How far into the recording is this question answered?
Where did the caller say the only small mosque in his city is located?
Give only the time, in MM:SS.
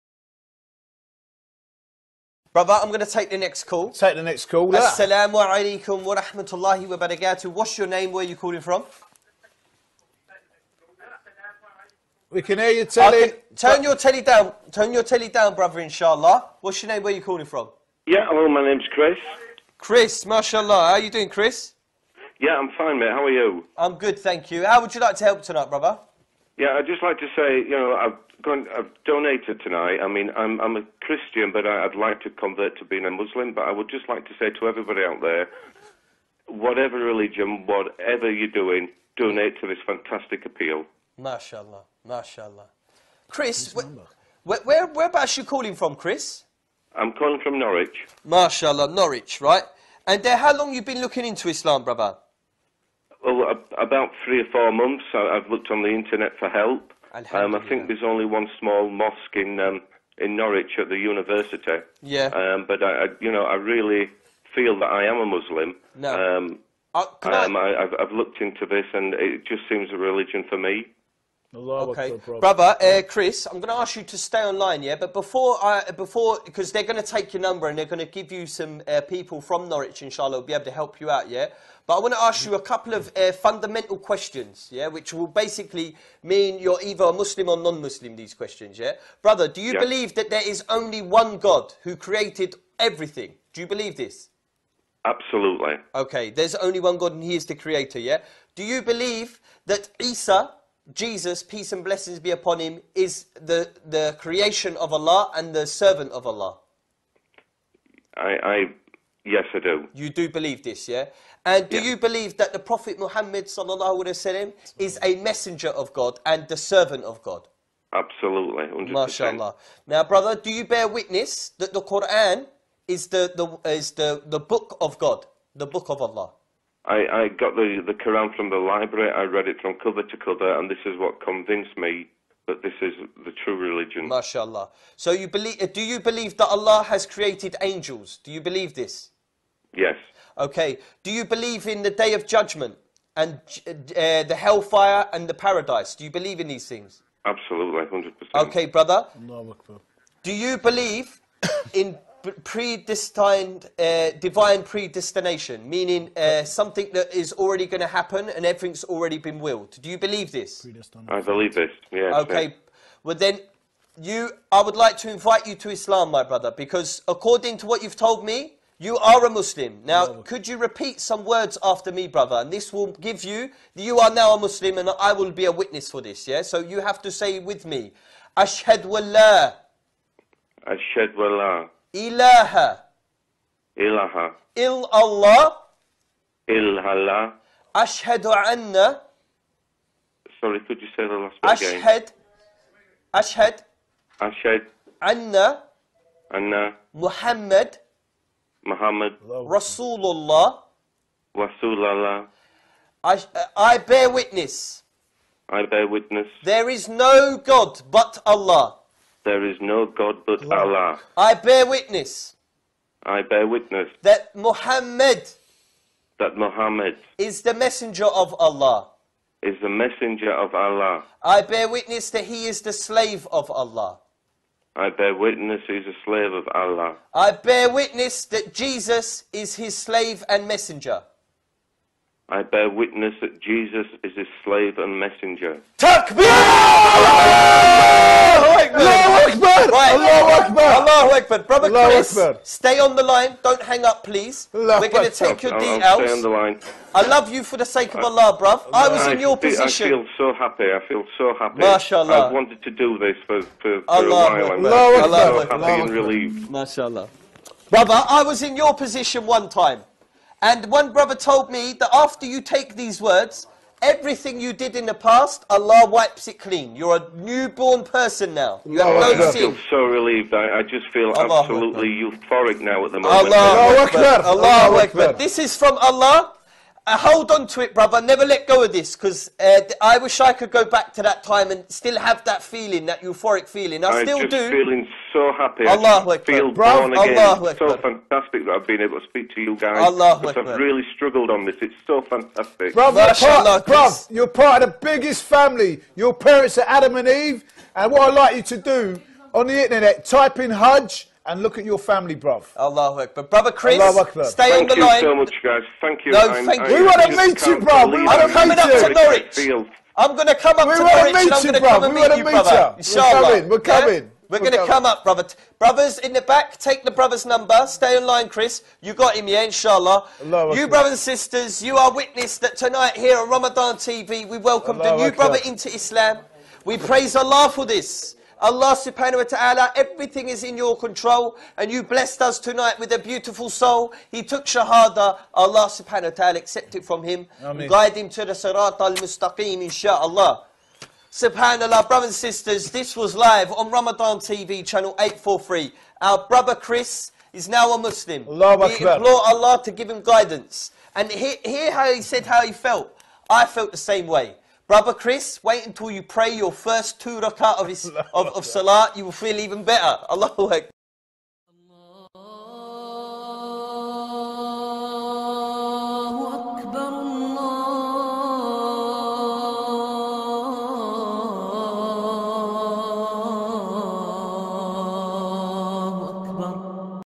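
01:00.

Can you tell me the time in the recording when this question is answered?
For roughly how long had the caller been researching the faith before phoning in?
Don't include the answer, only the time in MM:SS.
00:53.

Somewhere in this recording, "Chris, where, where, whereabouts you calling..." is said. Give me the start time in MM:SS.
00:43.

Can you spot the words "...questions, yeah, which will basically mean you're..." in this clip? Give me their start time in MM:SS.
01:23.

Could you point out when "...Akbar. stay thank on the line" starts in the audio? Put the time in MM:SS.
05:03.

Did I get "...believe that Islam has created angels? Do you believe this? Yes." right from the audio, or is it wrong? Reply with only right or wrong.
wrong.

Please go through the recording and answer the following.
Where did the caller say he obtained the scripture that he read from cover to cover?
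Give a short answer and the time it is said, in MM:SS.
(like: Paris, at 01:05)
the library, at 02:08.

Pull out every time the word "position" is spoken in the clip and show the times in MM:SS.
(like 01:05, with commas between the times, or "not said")
04:09, 04:18.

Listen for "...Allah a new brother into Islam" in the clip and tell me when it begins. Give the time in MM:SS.
05:24.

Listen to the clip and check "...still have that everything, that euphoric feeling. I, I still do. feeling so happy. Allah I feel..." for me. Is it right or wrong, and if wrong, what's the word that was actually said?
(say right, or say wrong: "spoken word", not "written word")
wrong: "feeling", not "everything".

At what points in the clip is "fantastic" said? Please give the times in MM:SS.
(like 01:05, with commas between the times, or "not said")
00:39, 04:47, 04:52.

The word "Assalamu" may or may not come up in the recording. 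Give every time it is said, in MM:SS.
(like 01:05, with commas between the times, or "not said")
00:04.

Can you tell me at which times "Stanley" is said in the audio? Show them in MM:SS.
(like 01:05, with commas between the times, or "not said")
not said.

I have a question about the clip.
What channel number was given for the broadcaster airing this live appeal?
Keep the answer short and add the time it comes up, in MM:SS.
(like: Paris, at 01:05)
843, at 05:44.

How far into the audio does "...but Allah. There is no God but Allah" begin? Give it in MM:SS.
03:27.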